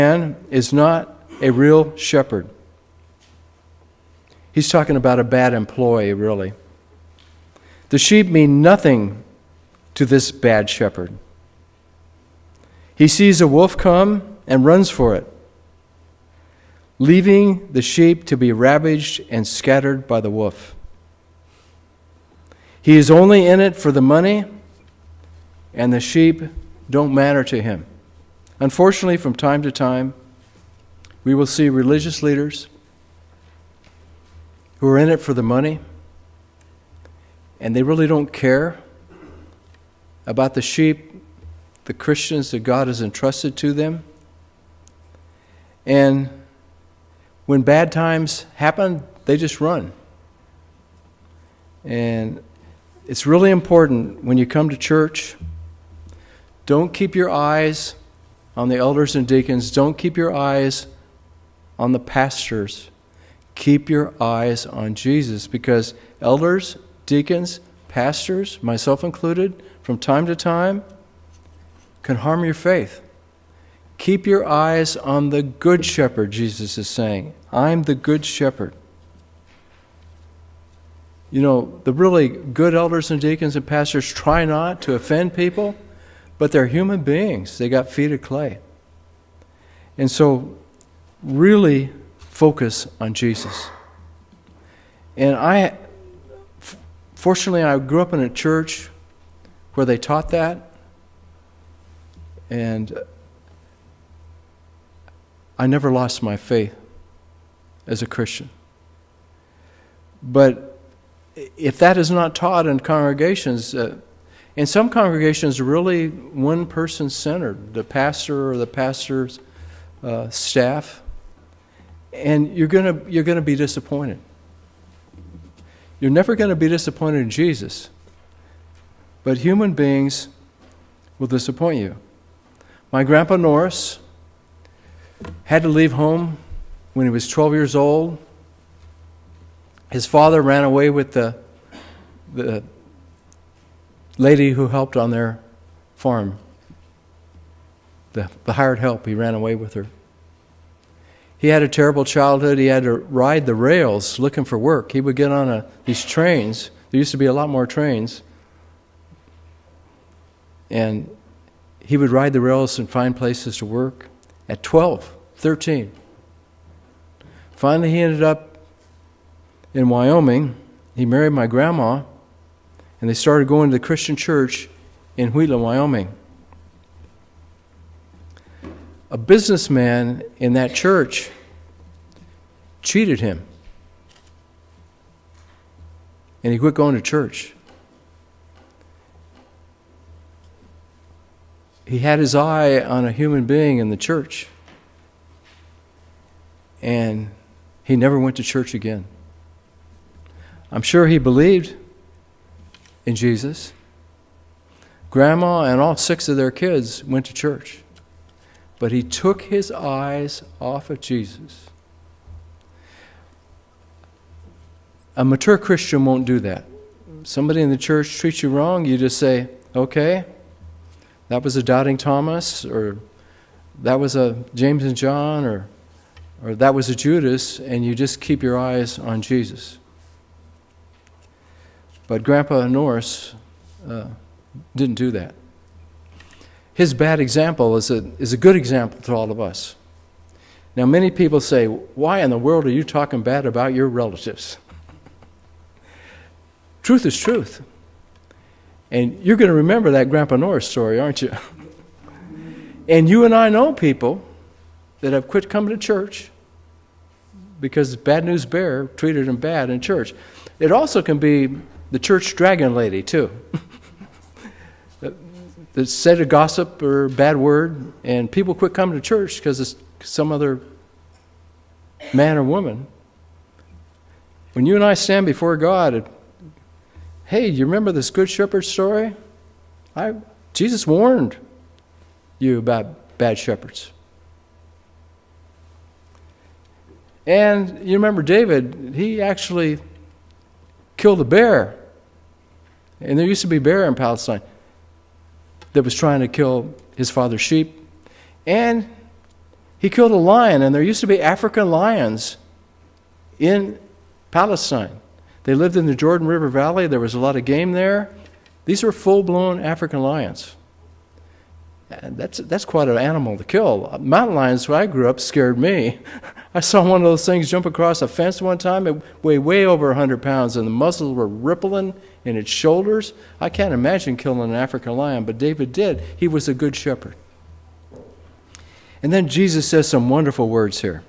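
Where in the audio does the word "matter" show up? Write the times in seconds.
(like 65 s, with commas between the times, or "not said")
27 s.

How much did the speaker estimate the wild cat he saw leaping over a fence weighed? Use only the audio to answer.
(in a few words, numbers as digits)
Over 100 pounds.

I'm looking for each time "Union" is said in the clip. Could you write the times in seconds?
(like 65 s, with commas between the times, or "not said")
not said.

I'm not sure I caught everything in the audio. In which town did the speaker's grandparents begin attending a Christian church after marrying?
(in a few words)
Wheeler, Wyoming.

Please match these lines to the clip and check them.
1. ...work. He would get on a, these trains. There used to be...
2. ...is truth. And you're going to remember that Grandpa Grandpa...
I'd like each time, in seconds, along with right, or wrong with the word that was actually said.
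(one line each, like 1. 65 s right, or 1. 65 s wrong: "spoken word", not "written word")
1. 154 s right
2. 247 s wrong: "Norris", not "Grandpa".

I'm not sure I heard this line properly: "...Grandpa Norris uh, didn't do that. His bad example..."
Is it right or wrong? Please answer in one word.
right.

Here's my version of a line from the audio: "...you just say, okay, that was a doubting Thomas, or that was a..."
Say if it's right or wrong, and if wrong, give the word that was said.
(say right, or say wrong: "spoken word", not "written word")
right.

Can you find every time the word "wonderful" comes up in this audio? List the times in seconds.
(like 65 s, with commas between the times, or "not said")
330 s.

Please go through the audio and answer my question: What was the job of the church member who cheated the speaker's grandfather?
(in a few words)
Businessman.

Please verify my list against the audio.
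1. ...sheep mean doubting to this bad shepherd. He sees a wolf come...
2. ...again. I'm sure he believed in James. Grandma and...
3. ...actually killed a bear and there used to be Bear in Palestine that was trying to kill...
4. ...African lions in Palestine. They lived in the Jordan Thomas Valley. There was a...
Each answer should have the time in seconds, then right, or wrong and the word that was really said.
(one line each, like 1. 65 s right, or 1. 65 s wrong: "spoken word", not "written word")
1. 7 s wrong: "nothing", not "doubting"
2. 198 s wrong: "Jesus", not "James"
3. 289 s right
4. 301 s wrong: "River", not "Thomas".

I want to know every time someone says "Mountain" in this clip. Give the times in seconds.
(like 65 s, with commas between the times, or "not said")
313 s.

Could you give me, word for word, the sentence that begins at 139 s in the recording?
His father ran away with the the lady who helped on their farm, the, the hired help, he ran away with her.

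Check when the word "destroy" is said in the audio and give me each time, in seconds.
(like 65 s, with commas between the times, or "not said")
not said.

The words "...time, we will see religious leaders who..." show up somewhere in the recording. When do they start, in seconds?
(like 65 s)
29 s.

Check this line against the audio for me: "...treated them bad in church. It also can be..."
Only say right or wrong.
right.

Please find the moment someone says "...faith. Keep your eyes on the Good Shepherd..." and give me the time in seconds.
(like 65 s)
72 s.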